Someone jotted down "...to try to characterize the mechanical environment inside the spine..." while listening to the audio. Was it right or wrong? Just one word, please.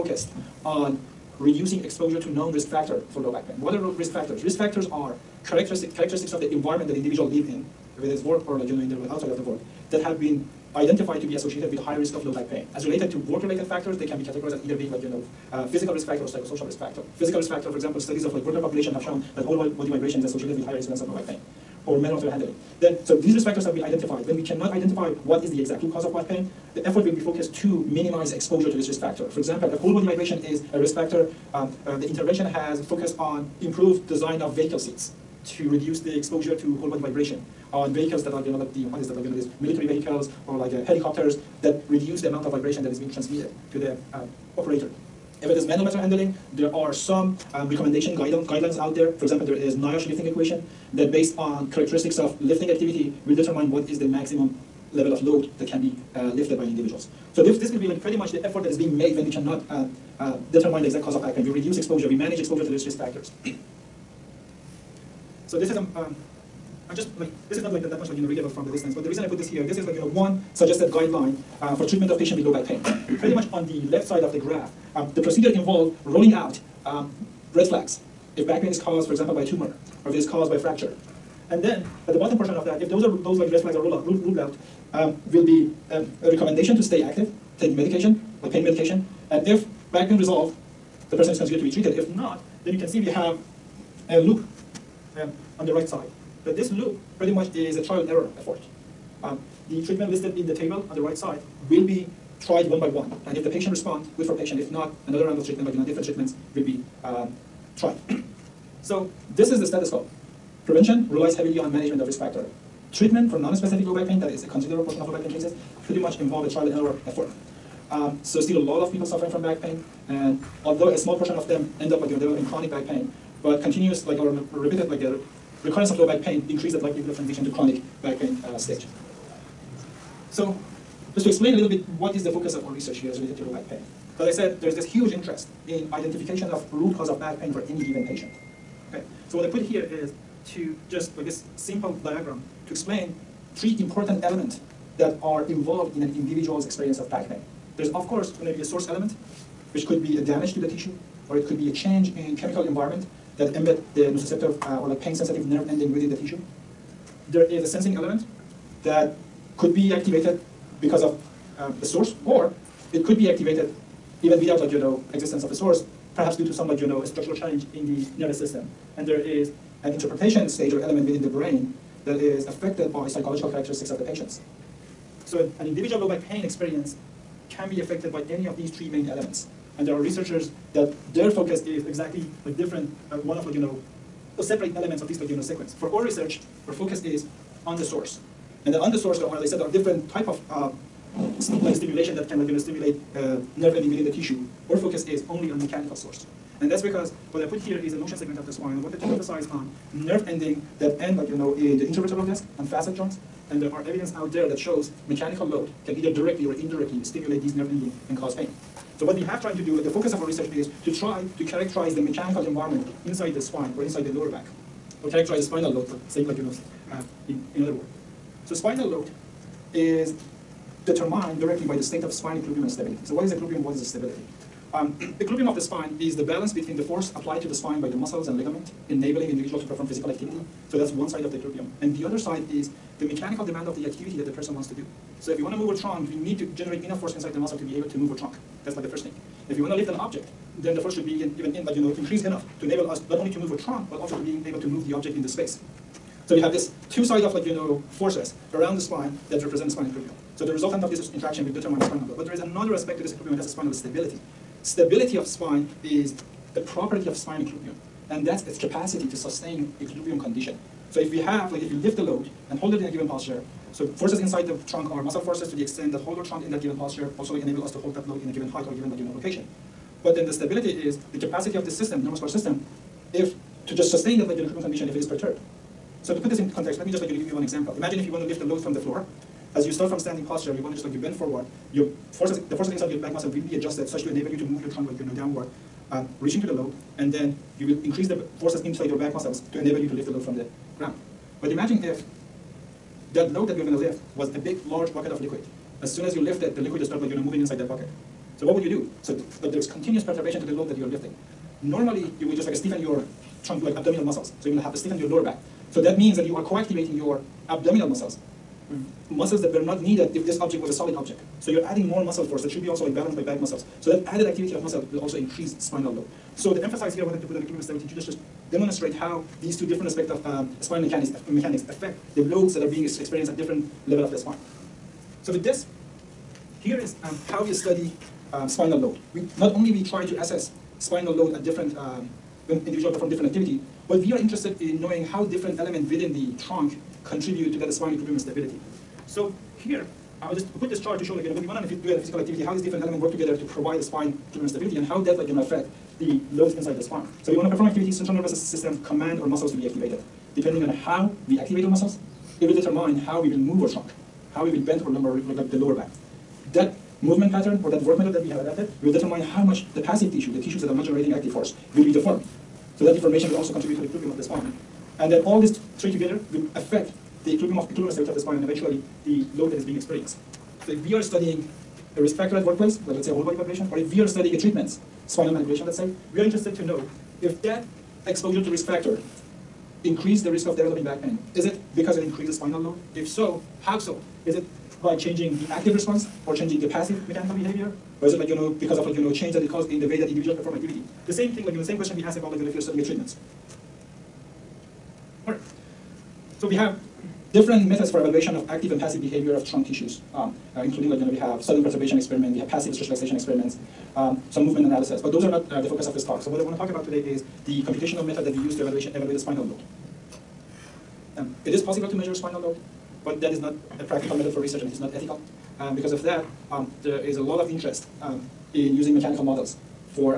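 right.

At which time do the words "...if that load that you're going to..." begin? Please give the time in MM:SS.
04:51.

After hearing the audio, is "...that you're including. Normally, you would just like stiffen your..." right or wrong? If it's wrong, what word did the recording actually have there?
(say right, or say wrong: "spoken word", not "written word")
wrong: "lifting", not "including".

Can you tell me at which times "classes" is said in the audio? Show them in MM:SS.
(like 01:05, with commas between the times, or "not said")
not said.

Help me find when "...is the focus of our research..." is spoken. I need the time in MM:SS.
02:12.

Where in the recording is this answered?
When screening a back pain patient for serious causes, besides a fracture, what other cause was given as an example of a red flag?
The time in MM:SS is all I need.
01:19.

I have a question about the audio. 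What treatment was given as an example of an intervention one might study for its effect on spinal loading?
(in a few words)
Spinal manipulation.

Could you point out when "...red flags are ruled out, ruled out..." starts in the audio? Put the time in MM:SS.
01:23.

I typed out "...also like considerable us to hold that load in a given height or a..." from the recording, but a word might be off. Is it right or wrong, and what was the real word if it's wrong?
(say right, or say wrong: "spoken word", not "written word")
wrong: "enable", not "considerable".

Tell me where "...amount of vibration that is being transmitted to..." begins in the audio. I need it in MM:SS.
00:42.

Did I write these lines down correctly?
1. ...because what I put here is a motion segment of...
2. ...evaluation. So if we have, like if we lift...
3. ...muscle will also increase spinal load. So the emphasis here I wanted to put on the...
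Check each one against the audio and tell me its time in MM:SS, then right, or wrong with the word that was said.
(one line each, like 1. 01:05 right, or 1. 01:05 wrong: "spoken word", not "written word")
1. 03:16 right
2. 04:20 wrong: "condition", not "evaluation"
3. 05:14 right.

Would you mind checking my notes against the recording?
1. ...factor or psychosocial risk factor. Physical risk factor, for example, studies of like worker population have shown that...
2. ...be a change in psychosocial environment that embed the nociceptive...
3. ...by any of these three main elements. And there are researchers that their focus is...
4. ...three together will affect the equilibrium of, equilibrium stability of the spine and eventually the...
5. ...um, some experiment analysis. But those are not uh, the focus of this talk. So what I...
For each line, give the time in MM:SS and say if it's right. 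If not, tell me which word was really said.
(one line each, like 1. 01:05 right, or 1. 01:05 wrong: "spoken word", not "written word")
1. 00:16 right
2. 02:31 wrong: "chemical", not "psychosocial"
3. 02:58 right
4. 06:05 right
5. 06:43 wrong: "movement", not "experiment".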